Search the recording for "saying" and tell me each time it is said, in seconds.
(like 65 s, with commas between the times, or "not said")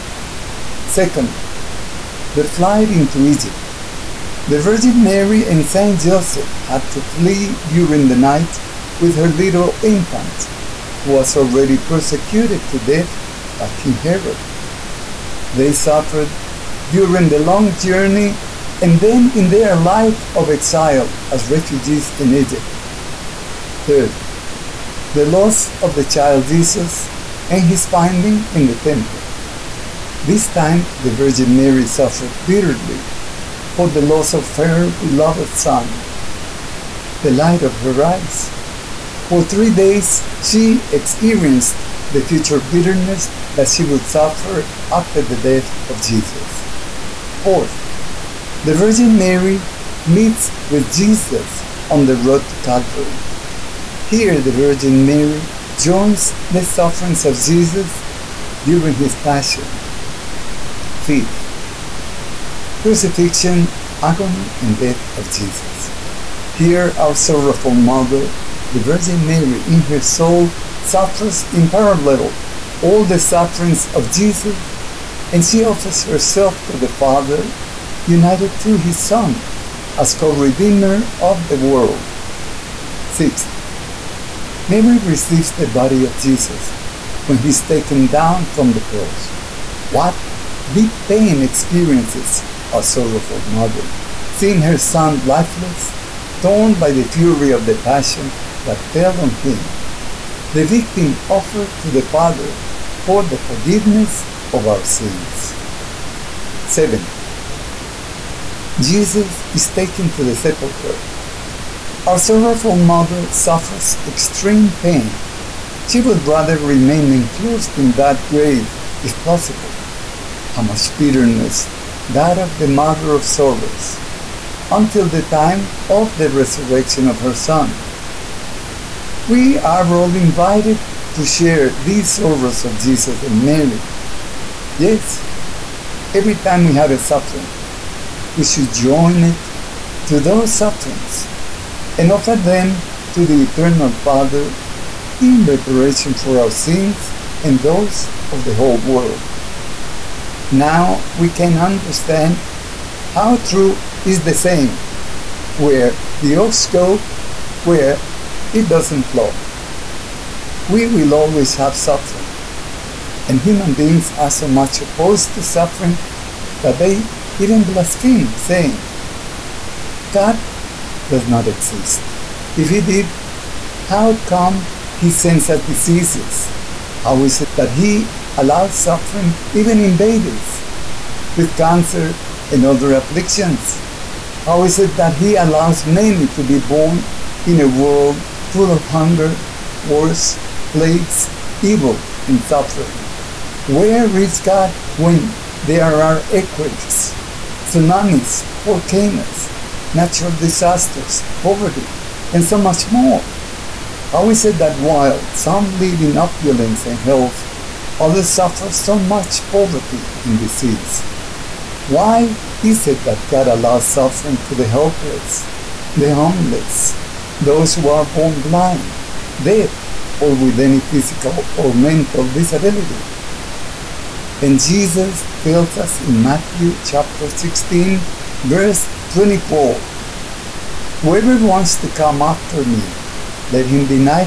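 154 s, 168 s.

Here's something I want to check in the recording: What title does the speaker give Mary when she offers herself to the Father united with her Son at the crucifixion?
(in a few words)
co-redeemer of the world.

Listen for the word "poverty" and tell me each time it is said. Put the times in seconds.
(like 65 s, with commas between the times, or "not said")
201 s, 209 s.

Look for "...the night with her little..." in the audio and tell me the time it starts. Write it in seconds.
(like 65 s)
8 s.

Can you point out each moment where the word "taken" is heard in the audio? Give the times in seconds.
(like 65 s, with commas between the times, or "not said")
87 s, 109 s.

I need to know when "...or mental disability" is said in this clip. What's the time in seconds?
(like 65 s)
221 s.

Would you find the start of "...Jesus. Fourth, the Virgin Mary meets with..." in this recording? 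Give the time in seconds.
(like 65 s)
46 s.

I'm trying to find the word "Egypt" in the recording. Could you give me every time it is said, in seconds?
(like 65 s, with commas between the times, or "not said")
3 s, 22 s.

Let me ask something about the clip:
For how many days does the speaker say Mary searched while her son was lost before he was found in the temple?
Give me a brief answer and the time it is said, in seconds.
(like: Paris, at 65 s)
3, at 39 s.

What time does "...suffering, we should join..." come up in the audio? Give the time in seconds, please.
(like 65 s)
136 s.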